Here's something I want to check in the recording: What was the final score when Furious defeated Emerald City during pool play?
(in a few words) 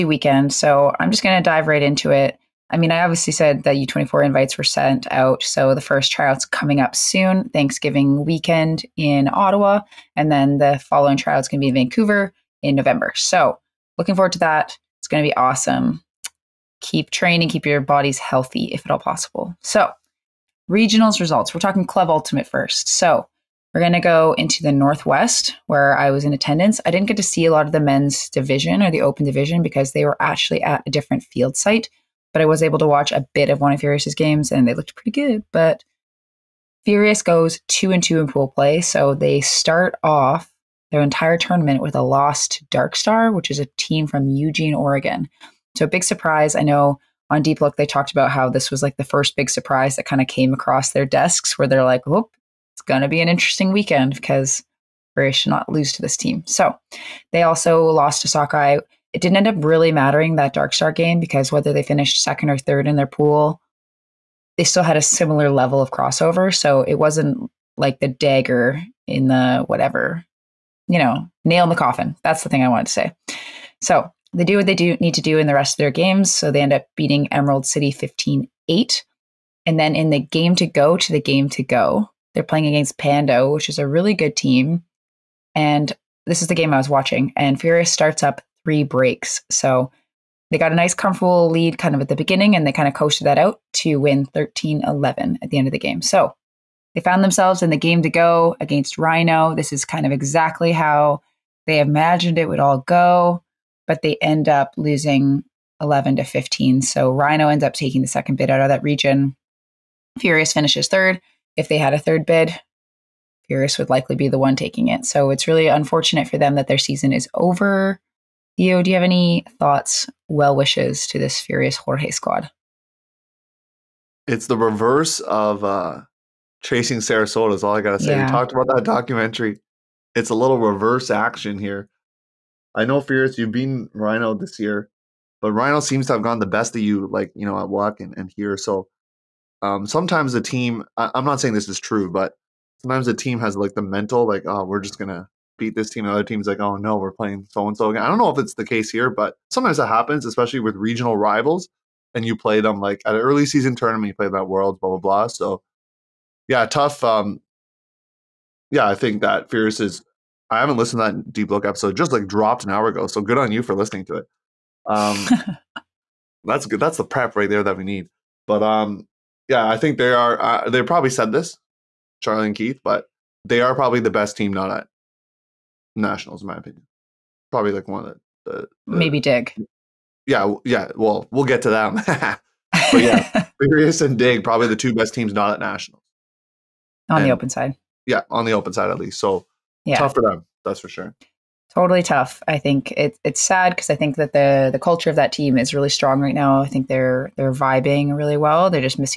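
15-8.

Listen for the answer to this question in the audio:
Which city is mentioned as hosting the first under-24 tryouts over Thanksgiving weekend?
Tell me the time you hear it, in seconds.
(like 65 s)
9 s.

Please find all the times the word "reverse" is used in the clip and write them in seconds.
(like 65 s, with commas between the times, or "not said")
124 s, 130 s.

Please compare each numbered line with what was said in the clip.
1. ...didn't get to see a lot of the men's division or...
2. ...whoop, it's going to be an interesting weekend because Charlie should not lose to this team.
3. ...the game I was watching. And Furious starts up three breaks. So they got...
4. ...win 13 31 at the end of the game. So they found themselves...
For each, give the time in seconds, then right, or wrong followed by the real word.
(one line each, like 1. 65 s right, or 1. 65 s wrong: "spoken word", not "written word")
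1. 26 s right
2. 52 s wrong: "British", not "Charlie"
3. 86 s right
4. 93 s wrong: "11", not "31".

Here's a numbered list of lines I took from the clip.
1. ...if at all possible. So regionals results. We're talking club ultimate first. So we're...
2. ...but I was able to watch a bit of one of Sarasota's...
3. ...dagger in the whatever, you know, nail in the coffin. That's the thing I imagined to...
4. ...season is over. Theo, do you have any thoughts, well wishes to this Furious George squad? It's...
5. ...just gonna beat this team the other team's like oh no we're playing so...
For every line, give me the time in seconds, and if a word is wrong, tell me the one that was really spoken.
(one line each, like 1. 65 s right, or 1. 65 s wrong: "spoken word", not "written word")
1. 18 s right
2. 32 s wrong: "Furious", not "Sarasota"
3. 68 s wrong: "wanted", not "imagined"
4. 116 s right
5. 144 s right.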